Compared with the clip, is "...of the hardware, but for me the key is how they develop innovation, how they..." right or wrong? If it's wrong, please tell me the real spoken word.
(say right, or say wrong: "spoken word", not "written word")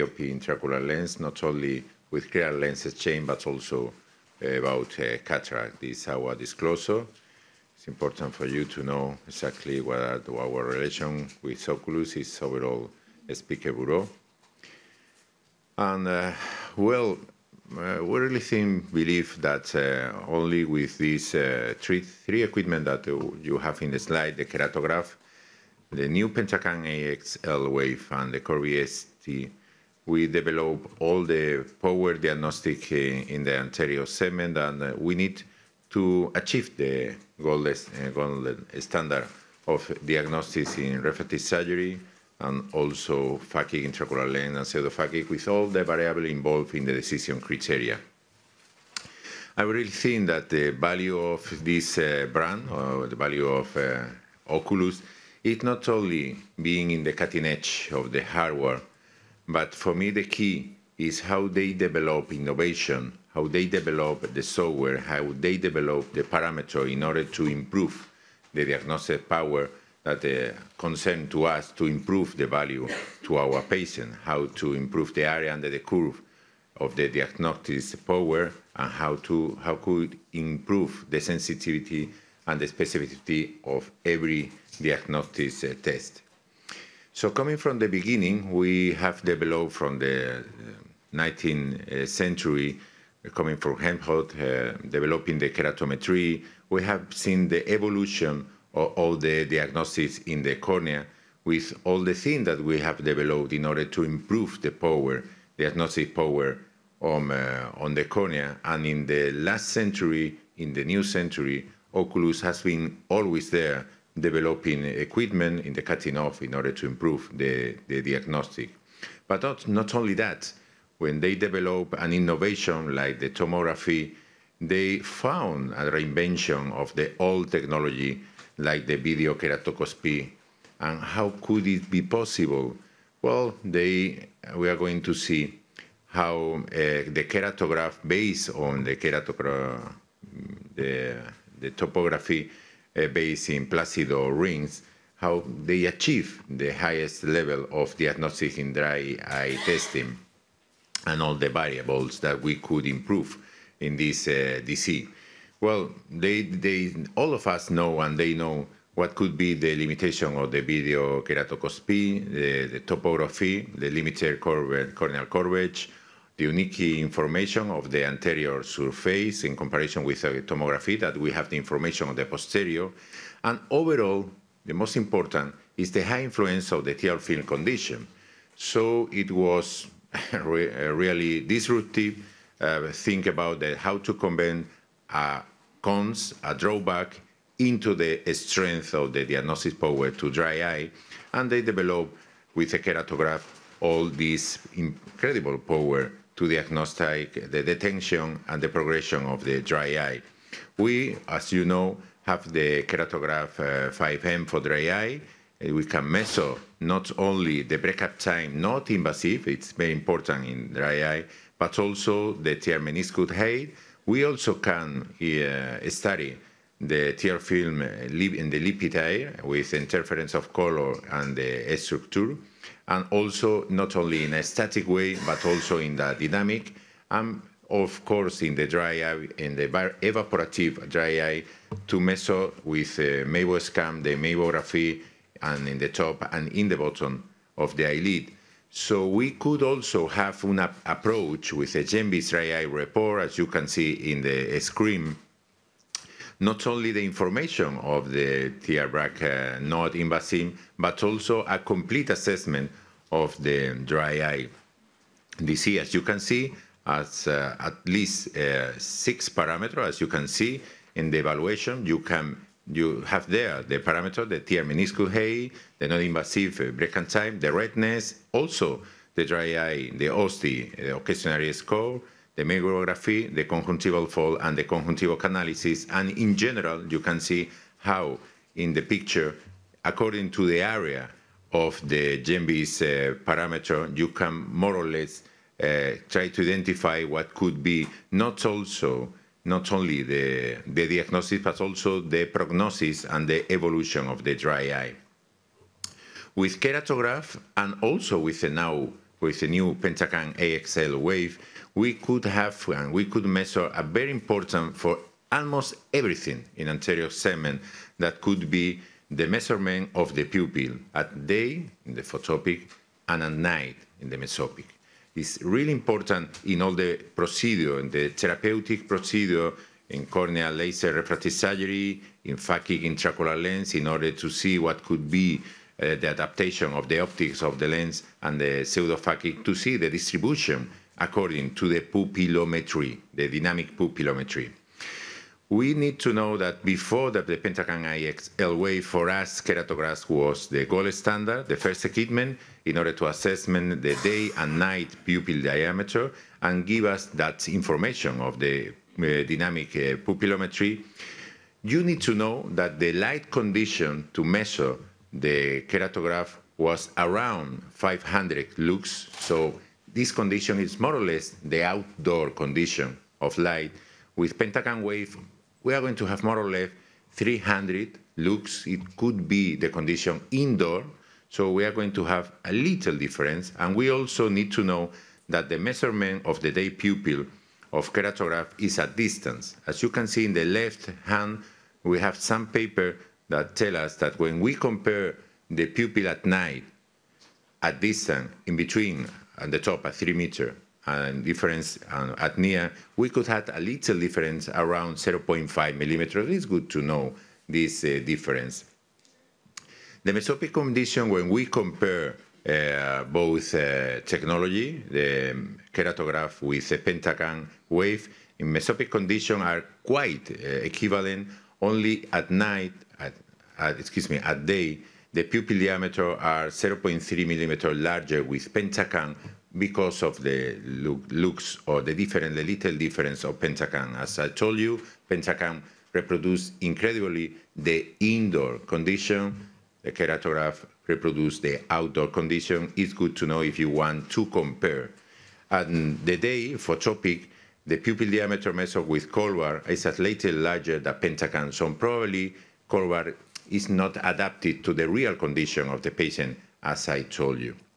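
right.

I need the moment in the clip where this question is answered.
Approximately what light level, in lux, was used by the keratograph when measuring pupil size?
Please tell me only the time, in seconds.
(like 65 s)
357 s.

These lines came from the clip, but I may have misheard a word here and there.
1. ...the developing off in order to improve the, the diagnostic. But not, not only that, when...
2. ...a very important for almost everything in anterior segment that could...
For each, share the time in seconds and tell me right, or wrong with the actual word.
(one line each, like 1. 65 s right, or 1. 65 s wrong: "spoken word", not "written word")
1. 115 s wrong: "cutting", not "developing"
2. 303 s right.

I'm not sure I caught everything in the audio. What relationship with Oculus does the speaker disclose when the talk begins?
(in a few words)
Speaker bureau.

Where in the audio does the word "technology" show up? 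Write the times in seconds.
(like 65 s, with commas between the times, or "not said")
127 s, 404 s.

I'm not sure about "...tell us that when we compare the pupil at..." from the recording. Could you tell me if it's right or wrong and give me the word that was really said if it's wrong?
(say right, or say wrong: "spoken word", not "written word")
right.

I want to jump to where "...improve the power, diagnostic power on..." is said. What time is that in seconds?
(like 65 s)
104 s.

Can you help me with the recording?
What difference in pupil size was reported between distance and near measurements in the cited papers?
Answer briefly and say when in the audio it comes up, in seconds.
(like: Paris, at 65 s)
0.5 millimeters, at 394 s.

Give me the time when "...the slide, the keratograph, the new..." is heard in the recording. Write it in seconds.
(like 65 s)
23 s.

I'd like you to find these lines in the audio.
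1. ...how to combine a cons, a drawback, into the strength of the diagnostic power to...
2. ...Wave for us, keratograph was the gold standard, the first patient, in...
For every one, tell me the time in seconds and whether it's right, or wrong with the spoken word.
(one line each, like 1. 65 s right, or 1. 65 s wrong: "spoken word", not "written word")
1. 183 s right
2. 338 s wrong: "equipment", not "patient".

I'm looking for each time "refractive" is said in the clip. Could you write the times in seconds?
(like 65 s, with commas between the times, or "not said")
41 s, 320 s.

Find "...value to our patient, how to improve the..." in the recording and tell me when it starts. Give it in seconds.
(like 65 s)
72 s.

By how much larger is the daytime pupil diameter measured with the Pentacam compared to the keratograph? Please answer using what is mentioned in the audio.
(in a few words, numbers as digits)
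0.3 millimeter.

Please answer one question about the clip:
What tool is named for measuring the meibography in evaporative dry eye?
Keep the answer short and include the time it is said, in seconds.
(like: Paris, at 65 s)
Meibo-Scan, at 233 s.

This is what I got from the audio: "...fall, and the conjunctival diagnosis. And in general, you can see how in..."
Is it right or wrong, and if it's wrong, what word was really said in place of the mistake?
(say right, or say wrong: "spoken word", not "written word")
wrong: "analysis", not "diagnosis".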